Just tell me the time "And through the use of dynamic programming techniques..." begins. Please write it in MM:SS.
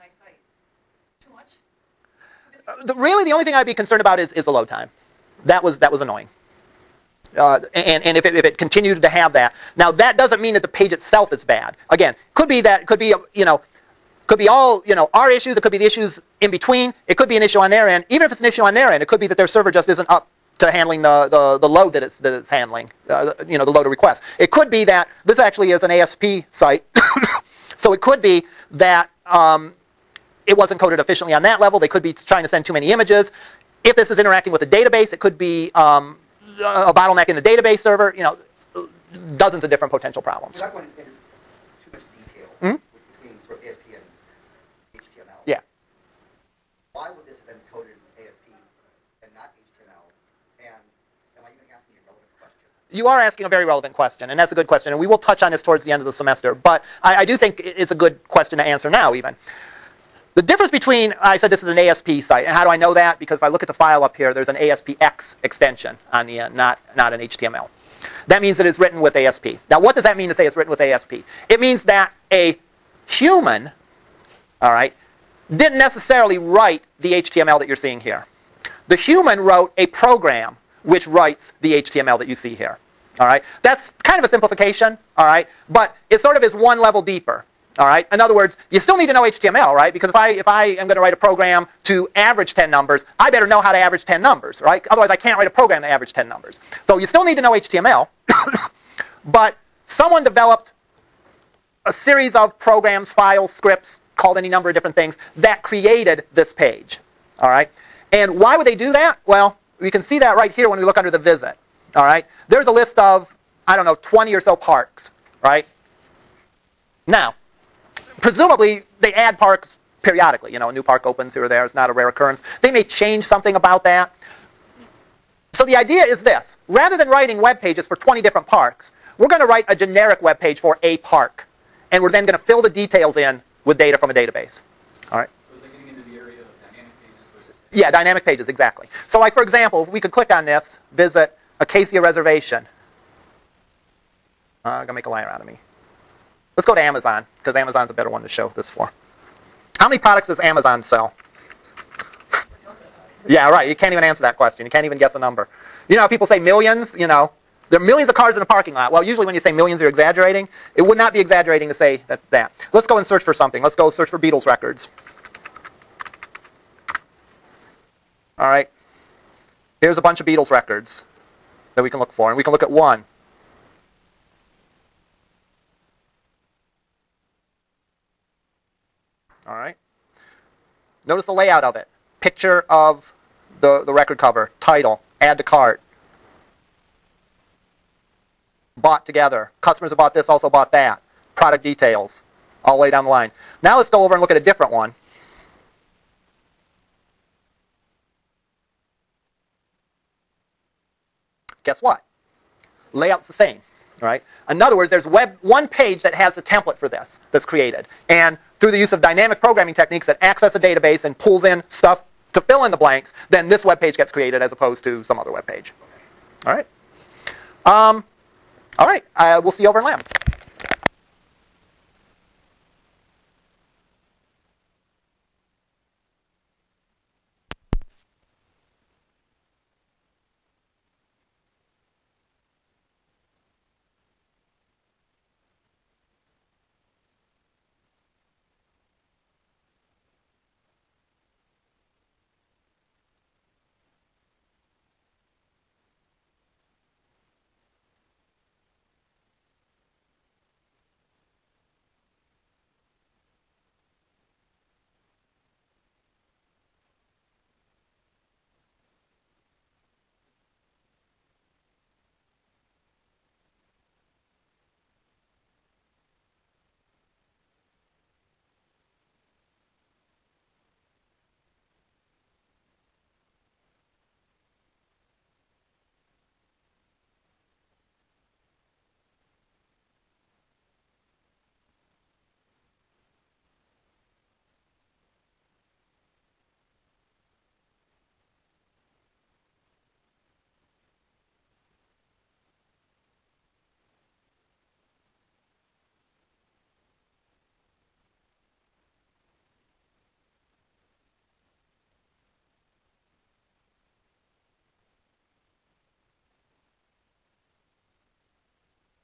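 03:28.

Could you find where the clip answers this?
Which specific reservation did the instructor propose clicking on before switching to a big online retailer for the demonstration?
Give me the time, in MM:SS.
02:21.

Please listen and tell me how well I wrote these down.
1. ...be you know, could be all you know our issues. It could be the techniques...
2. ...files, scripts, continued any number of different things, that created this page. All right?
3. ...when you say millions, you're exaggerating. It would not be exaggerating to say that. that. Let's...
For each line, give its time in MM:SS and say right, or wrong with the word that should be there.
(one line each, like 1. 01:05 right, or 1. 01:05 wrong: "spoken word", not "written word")
1. 00:12 wrong: "issues", not "techniques"
2. 01:43 wrong: "called", not "continued"
3. 02:39 right.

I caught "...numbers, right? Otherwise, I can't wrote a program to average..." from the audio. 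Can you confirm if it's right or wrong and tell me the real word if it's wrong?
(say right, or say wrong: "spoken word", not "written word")
wrong: "write", not "wrote".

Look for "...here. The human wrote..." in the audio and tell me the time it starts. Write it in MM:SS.
01:17.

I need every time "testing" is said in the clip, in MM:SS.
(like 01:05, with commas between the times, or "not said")
not said.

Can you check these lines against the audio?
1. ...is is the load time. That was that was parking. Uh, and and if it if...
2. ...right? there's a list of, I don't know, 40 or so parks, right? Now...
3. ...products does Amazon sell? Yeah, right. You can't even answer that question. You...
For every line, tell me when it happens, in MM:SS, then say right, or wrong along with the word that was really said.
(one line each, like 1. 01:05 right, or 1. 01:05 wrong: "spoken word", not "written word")
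1. 00:04 wrong: "annoying", not "parking"
2. 01:52 wrong: "20", not "40"
3. 02:29 right.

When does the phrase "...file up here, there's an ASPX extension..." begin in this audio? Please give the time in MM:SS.
01:03.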